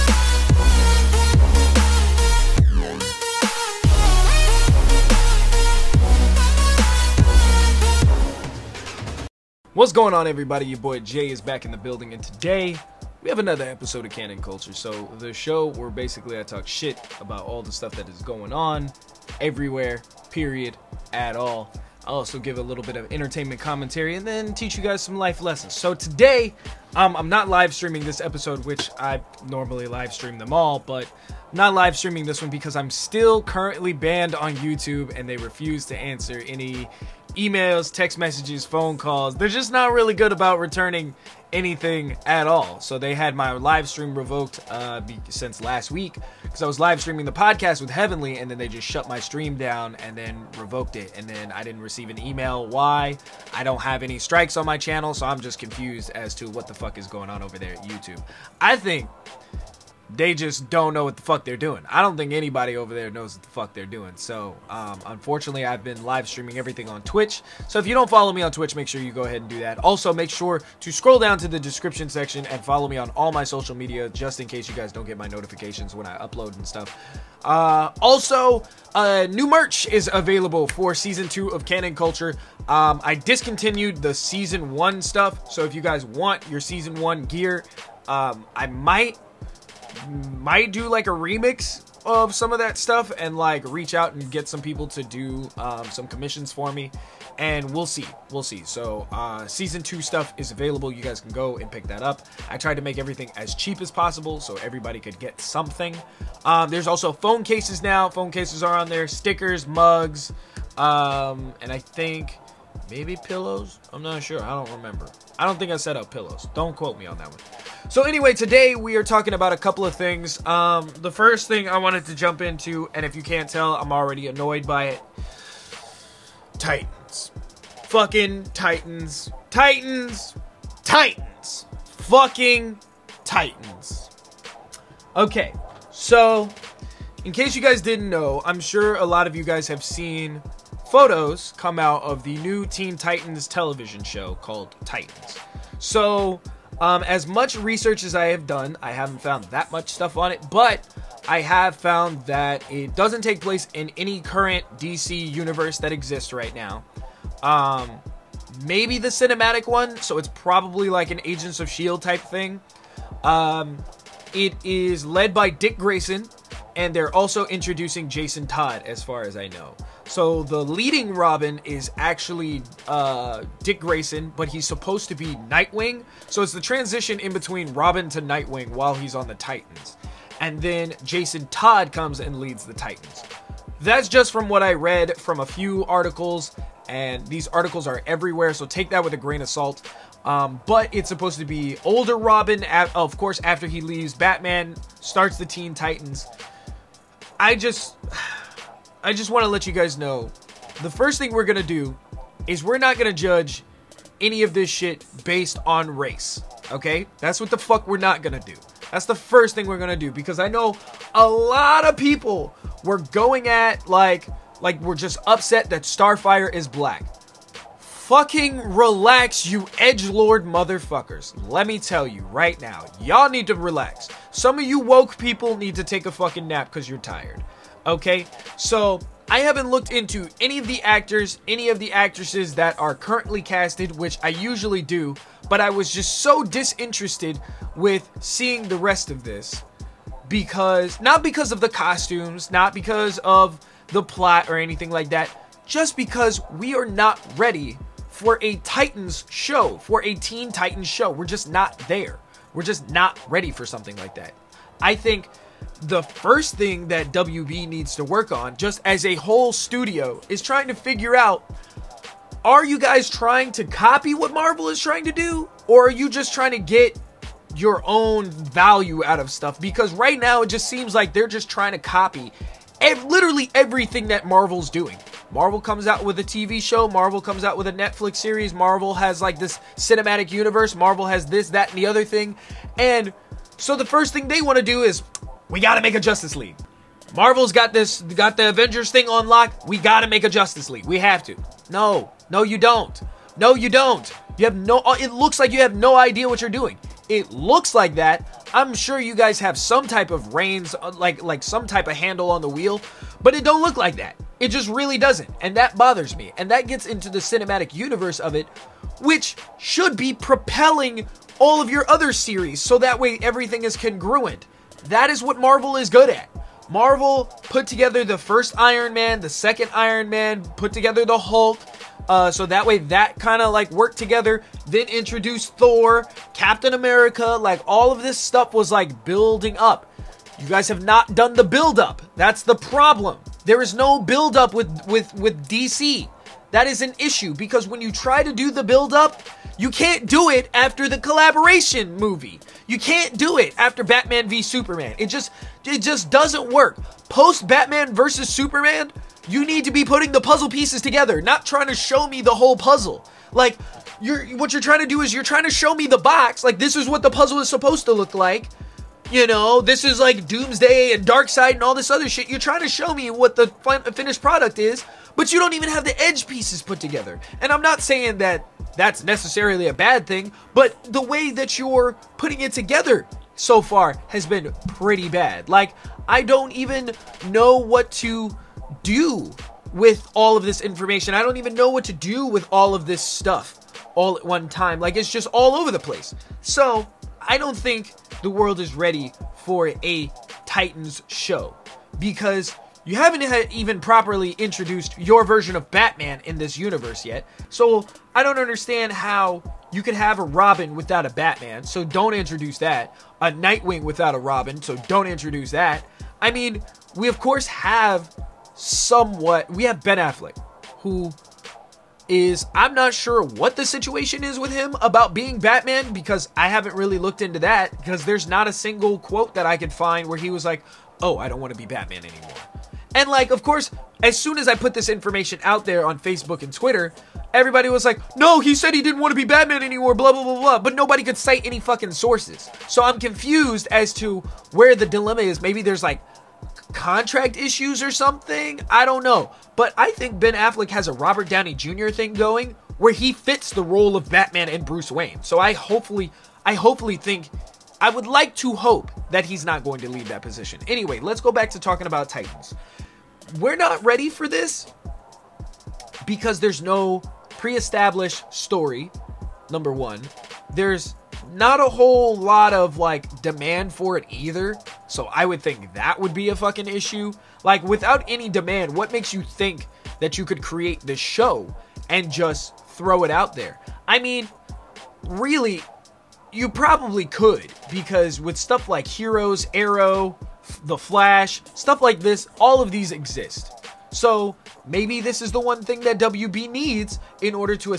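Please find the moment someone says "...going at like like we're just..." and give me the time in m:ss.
3:32.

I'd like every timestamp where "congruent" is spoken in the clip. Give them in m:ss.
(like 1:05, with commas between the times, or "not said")
5:13.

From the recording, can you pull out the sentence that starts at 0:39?
They're just not really good about returning anything at all.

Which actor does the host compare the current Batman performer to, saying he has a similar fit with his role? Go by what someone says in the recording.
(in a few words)
Robert Downey Jr.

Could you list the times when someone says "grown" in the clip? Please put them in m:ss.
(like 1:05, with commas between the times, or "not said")
not said.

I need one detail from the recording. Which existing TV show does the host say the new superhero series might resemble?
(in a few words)
Agents of S.H.I.E.L.D.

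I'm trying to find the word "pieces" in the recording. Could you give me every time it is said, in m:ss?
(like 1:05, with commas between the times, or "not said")
5:50, 6:06.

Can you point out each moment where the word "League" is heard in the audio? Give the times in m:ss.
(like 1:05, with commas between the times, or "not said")
4:46, 4:50.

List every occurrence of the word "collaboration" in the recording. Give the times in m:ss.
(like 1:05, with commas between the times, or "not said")
5:40.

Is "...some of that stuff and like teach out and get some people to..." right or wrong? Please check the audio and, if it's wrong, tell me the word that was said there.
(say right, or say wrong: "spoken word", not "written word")
wrong: "reach", not "teach".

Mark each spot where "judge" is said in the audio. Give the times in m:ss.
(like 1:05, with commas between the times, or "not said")
3:23.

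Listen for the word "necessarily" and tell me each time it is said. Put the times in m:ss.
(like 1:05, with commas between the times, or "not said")
6:09.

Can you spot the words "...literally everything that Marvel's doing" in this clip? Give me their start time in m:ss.
4:33.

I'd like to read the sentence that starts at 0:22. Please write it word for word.
I'll also give a little bit of entertainment commentary and then teach you guys some life lessons.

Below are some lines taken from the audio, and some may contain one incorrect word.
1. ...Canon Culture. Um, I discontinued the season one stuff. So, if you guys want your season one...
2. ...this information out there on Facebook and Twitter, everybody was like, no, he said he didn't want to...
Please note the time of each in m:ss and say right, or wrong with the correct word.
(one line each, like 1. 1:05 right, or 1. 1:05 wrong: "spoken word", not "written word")
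1. 1:21 right
2. 7:04 right.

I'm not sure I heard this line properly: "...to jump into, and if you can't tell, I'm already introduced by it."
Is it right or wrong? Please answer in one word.
wrong.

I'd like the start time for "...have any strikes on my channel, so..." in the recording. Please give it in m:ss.
0:53.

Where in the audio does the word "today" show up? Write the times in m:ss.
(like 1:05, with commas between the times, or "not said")
0:12, 0:25, 1:58.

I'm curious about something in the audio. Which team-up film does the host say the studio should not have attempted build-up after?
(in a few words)
Batman v Superman.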